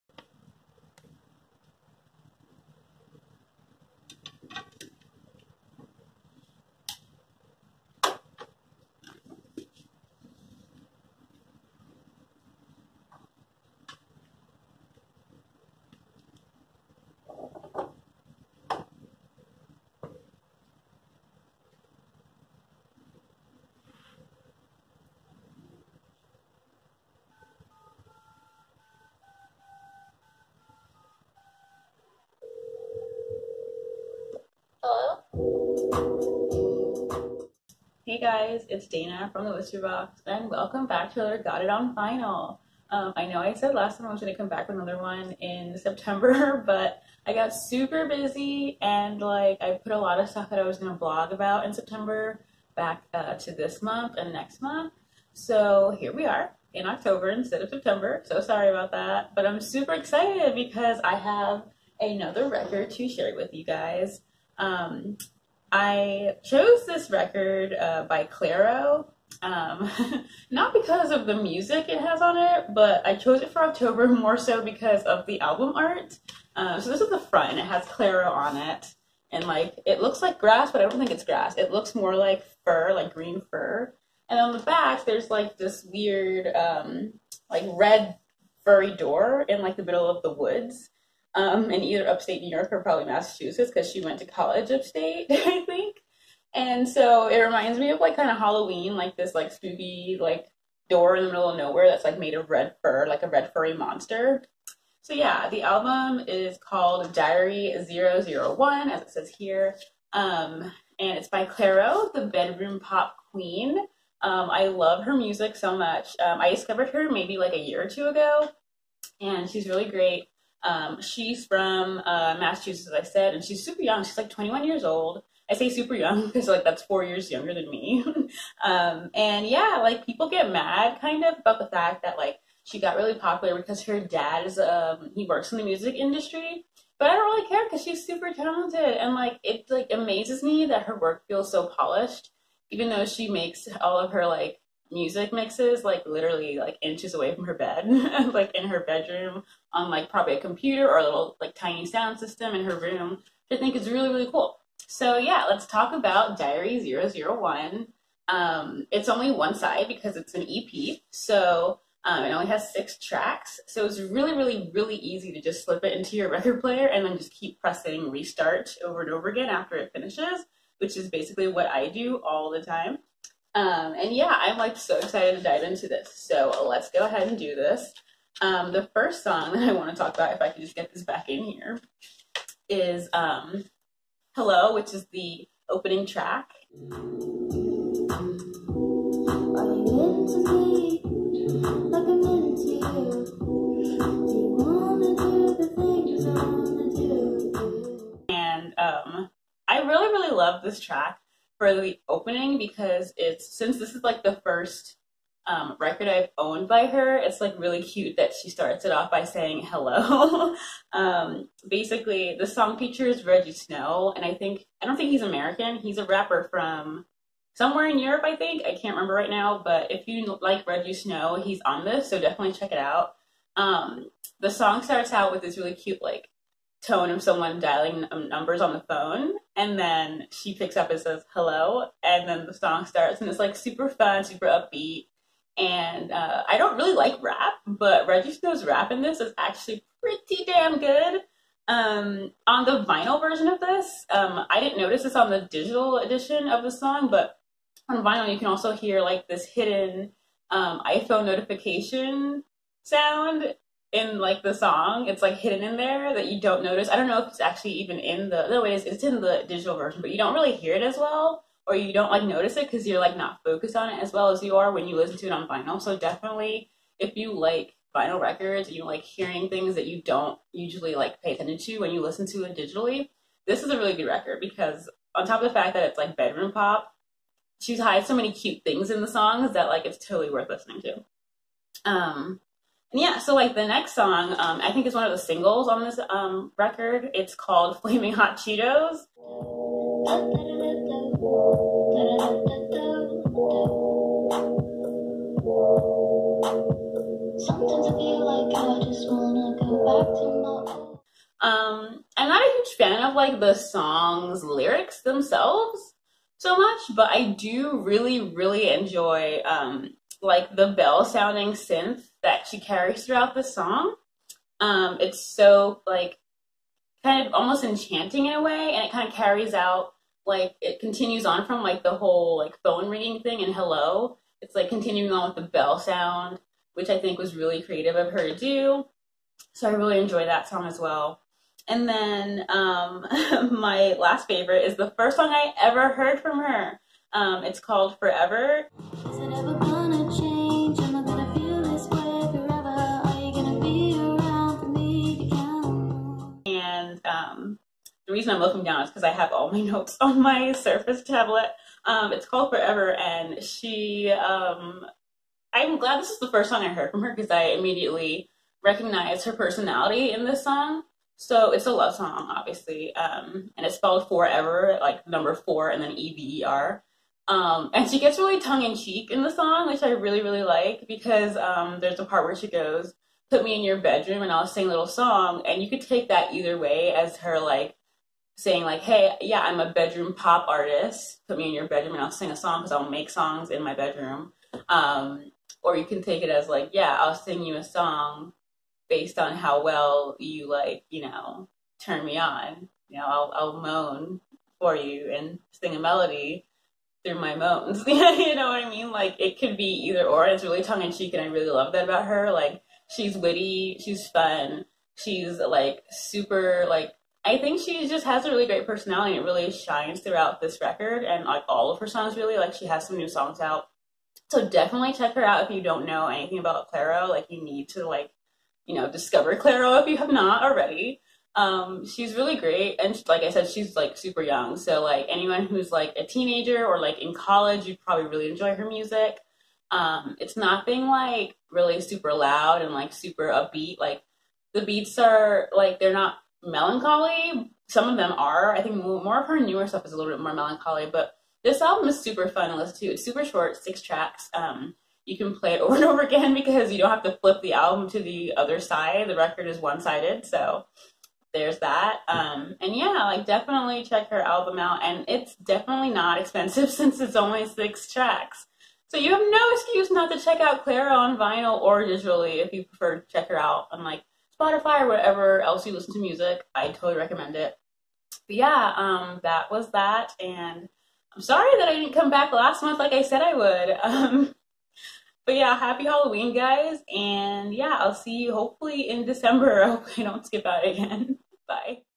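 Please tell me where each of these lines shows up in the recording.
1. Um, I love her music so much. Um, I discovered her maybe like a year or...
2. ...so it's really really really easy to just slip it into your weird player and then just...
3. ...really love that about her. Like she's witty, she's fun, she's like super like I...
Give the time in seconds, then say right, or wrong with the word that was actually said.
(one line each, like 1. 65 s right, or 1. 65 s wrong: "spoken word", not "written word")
1. 114 s right
2. 163 s wrong: "record", not "weird"
3. 401 s right.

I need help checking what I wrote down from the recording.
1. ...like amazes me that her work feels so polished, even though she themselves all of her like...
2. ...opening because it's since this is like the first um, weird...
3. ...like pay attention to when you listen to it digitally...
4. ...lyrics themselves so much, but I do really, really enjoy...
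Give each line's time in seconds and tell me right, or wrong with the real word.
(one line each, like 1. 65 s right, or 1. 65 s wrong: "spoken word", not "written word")
1. 139 s wrong: "makes", not "themselves"
2. 202 s wrong: "record", not "weird"
3. 270 s right
4. 304 s right.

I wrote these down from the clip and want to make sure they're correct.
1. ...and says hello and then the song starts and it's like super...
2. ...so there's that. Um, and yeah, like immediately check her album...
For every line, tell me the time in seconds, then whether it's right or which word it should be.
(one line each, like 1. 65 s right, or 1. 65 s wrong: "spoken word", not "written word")
1. 230 s right
2. 450 s wrong: "definitely", not "immediately".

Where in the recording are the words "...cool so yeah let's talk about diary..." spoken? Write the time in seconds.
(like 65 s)
154 s.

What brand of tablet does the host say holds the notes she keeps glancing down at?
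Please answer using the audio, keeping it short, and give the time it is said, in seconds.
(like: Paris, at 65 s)
Surface, at 350 s.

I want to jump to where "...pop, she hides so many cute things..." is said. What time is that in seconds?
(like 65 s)
276 s.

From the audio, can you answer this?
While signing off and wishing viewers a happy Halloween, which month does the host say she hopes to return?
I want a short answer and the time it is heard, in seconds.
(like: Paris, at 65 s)
December, at 479 s.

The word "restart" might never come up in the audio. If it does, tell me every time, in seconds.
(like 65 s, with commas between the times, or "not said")
168 s.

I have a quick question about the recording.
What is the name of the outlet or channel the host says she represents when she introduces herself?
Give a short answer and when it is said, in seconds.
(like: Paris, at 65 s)
The Whisper Box, at 39 s.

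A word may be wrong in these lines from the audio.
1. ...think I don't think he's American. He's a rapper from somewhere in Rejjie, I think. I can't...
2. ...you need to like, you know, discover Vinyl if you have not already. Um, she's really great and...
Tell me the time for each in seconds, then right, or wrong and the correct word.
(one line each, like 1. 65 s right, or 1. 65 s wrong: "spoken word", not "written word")
1. 214 s wrong: "Europe", not "Rejjie"
2. 417 s wrong: "Clairo", not "Vinyl".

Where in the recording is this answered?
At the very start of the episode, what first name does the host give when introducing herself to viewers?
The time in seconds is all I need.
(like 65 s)
38 s.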